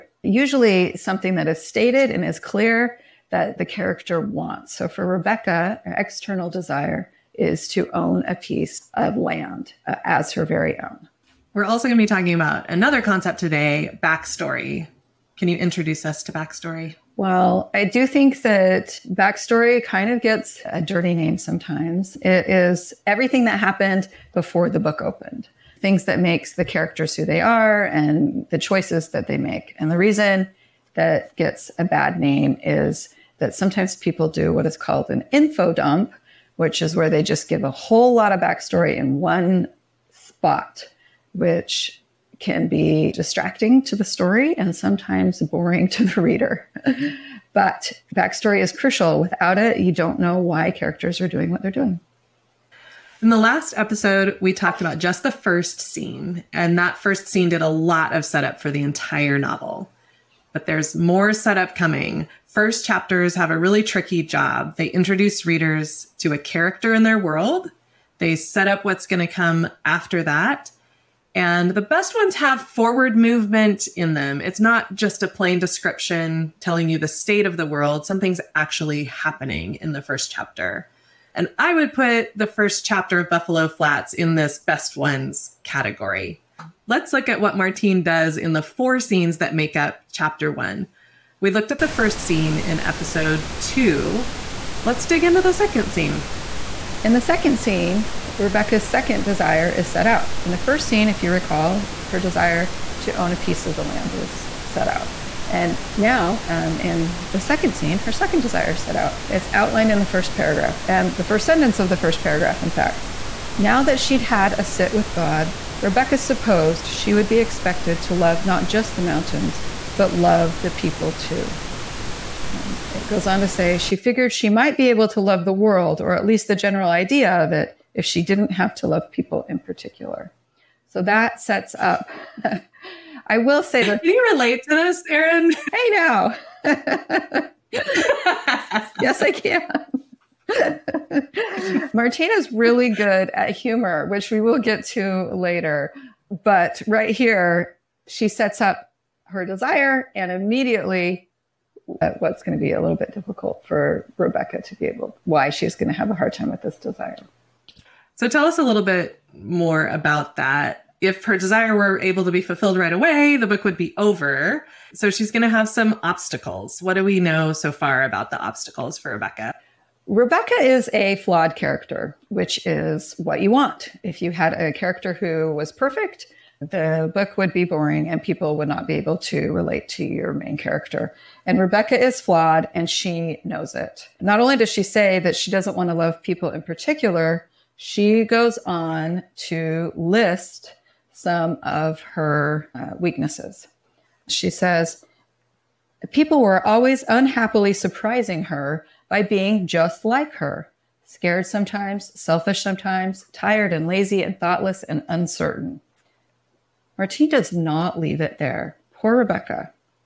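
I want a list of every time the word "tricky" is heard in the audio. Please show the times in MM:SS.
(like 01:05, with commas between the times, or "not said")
01:03.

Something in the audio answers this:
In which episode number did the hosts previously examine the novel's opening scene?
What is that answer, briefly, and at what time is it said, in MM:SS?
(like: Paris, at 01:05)
2, at 01:32.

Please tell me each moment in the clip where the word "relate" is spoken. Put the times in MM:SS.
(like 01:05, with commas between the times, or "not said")
02:14, 02:59.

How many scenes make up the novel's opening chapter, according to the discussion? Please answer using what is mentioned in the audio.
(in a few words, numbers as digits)
4.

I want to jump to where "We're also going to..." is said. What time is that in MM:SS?
00:11.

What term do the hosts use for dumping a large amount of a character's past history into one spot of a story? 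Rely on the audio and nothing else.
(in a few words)
Info dump.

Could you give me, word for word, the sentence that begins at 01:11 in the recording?
And the best ones have forward movement in them.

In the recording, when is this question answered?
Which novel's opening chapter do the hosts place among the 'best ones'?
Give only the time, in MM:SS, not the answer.
01:23.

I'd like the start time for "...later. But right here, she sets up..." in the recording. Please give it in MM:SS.
02:25.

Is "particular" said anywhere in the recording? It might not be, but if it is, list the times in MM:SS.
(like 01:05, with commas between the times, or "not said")
02:09, 03:06.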